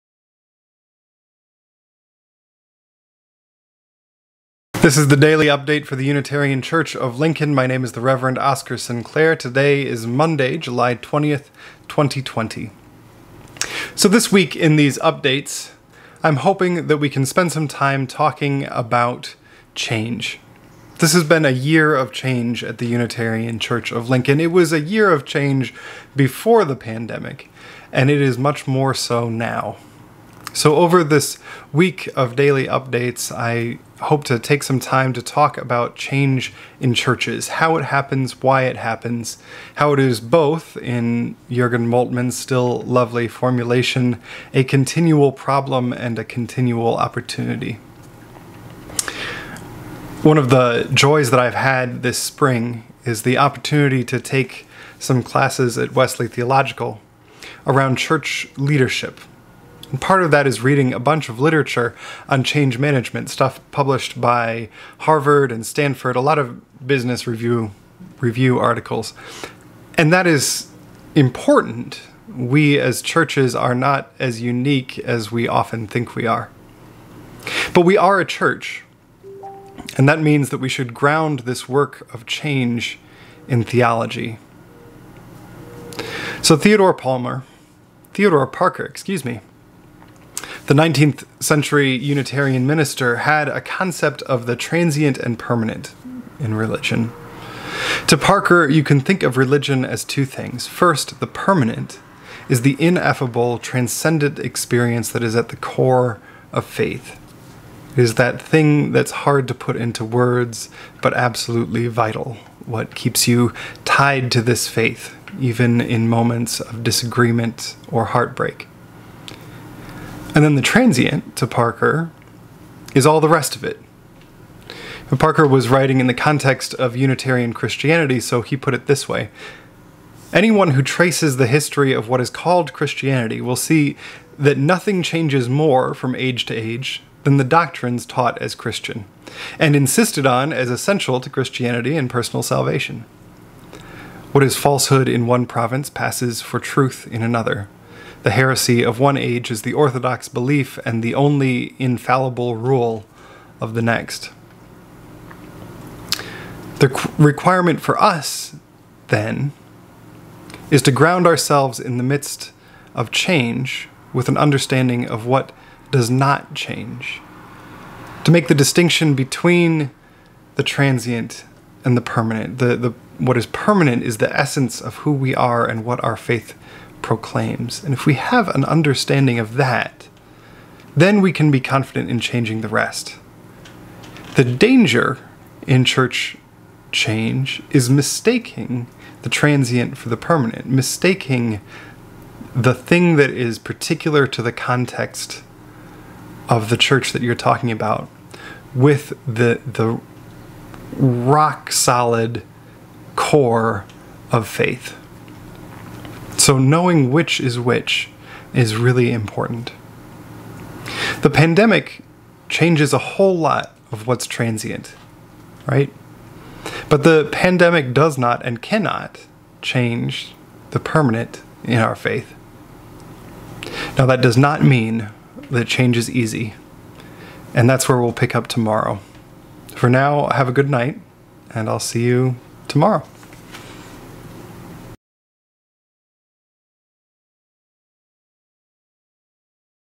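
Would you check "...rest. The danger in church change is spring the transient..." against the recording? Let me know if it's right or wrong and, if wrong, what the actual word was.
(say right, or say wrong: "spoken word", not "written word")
wrong: "mistaking", not "spring".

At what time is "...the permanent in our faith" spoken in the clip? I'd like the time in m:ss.
3:40.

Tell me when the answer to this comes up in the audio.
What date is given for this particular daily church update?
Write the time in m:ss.
0:10.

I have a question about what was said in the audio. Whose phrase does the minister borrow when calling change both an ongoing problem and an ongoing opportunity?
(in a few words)
Jurgen Moltmann.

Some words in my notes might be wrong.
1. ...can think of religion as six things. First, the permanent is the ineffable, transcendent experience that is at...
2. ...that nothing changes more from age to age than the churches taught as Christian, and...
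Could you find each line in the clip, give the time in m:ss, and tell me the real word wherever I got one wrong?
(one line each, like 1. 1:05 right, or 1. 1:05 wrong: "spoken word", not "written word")
1. 1:38 wrong: "two", not "six"
2. 2:14 wrong: "doctrines", not "churches".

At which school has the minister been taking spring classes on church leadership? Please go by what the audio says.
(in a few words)
Wesley Theological.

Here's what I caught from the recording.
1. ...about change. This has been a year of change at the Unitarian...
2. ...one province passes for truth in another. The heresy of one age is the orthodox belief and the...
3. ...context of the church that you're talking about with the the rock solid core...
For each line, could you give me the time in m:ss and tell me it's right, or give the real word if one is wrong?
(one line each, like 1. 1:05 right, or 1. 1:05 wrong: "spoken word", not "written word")
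1. 0:18 right
2. 2:25 right
3. 3:14 right.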